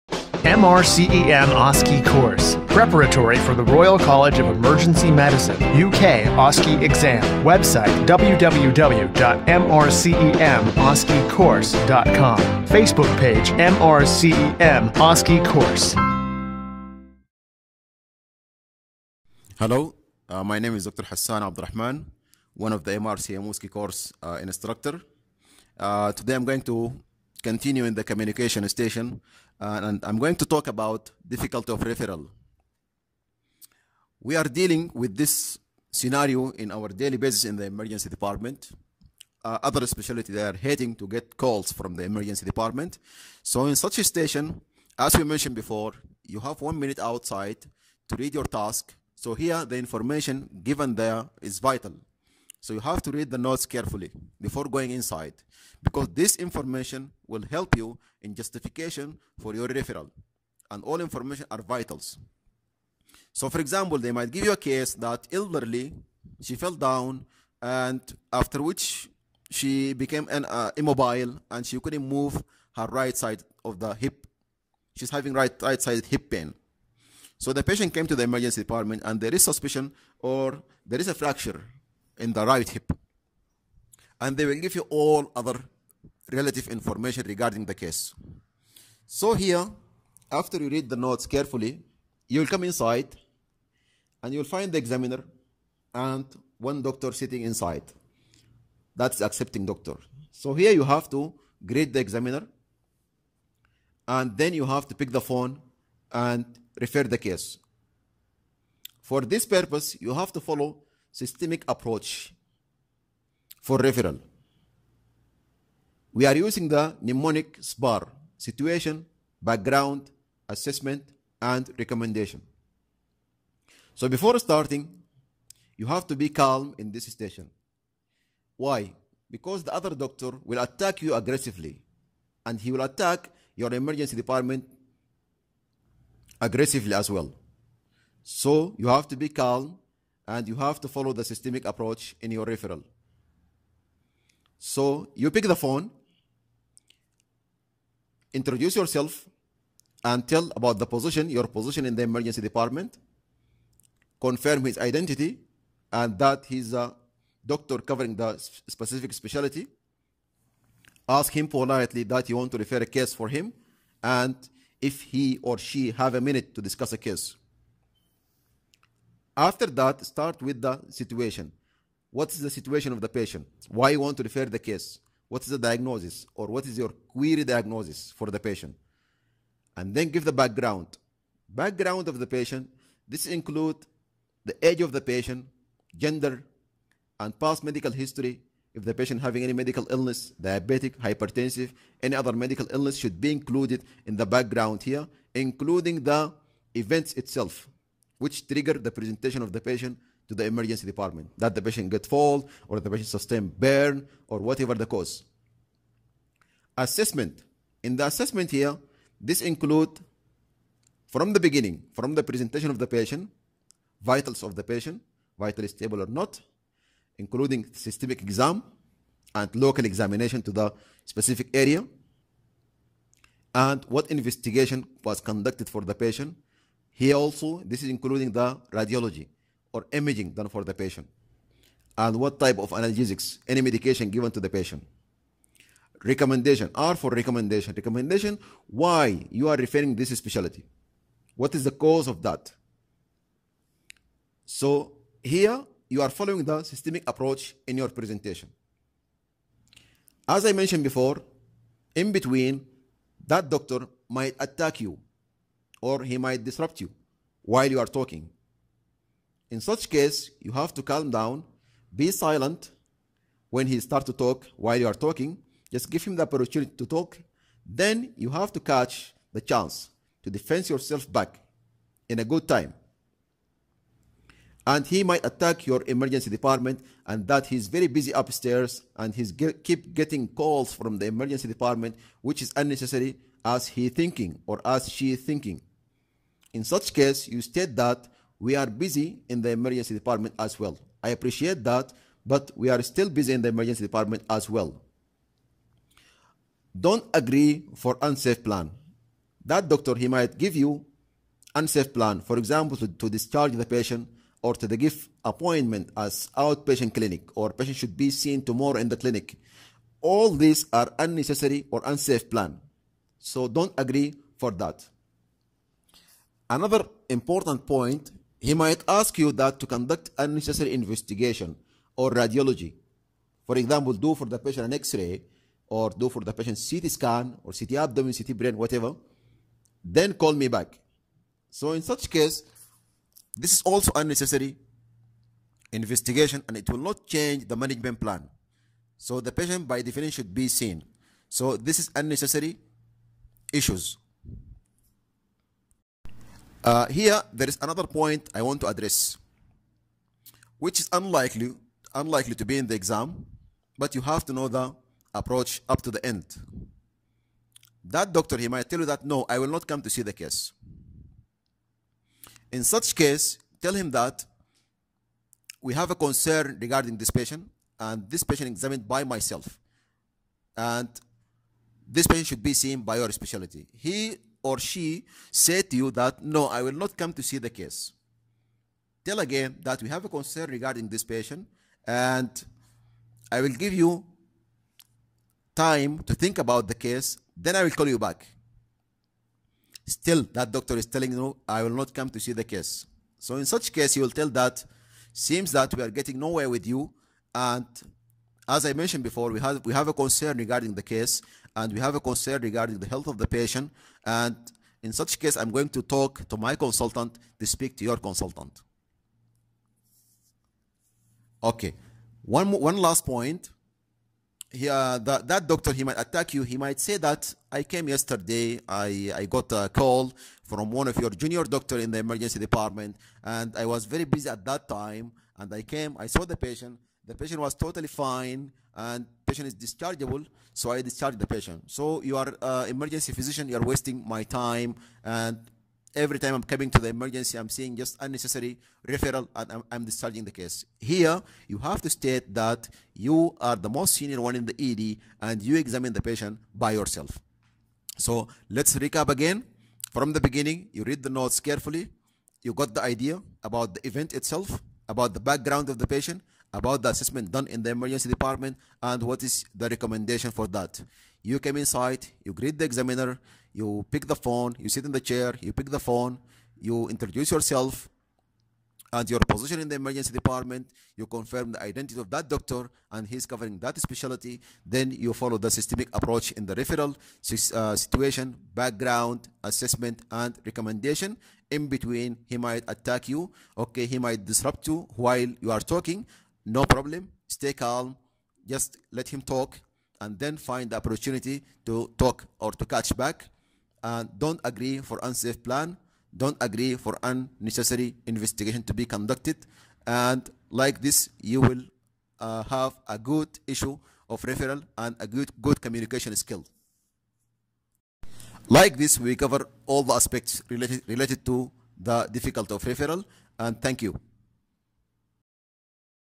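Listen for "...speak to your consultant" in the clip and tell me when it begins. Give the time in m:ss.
6:47.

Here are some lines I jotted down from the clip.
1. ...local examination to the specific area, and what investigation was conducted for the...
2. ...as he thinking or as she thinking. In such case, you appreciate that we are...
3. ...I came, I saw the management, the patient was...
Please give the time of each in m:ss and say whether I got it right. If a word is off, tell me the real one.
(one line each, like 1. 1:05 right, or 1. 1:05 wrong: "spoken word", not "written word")
1. 3:39 right
2. 4:43 wrong: "state", not "appreciate"
3. 7:05 wrong: "patient", not "management".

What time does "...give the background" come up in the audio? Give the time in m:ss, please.
3:00.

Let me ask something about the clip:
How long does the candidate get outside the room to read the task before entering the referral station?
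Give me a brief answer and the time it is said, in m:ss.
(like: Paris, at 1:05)
One minute, at 0:46.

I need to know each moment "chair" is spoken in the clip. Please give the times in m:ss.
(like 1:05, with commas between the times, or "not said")
7:44.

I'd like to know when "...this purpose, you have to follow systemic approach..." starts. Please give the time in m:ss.
1:49.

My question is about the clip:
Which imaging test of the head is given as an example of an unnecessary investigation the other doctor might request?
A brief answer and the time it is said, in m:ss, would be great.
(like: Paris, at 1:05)
CT brain, at 5:28.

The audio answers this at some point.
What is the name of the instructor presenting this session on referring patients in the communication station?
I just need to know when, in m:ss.
0:20.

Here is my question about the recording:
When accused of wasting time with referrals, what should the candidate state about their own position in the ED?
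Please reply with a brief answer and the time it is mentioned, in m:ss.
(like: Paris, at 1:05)
Most senior, at 7:23.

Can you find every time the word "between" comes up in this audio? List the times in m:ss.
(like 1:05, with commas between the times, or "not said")
4:12, 8:01.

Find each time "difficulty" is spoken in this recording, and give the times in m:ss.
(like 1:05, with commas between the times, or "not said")
0:31, 8:32.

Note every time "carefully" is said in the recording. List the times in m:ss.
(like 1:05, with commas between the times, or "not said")
0:53, 1:31, 7:31.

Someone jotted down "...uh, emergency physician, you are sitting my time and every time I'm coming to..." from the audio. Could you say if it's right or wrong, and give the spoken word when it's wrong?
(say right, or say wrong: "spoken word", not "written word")
wrong: "wasting", not "sitting".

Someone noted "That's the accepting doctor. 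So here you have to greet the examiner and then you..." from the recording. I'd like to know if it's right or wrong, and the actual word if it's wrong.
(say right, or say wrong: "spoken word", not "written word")
right.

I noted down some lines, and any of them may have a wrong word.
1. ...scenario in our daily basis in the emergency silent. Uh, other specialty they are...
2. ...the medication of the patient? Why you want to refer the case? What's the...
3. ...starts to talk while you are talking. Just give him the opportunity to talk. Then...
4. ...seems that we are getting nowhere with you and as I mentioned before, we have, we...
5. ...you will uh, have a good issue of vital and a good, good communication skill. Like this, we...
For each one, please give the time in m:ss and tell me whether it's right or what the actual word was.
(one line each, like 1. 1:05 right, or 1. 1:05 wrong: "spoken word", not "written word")
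1. 0:35 wrong: "department", not "silent"
2. 2:52 wrong: "situation", not "medication"
3. 4:23 right
4. 6:35 right
5. 8:21 wrong: "referral", not "vital".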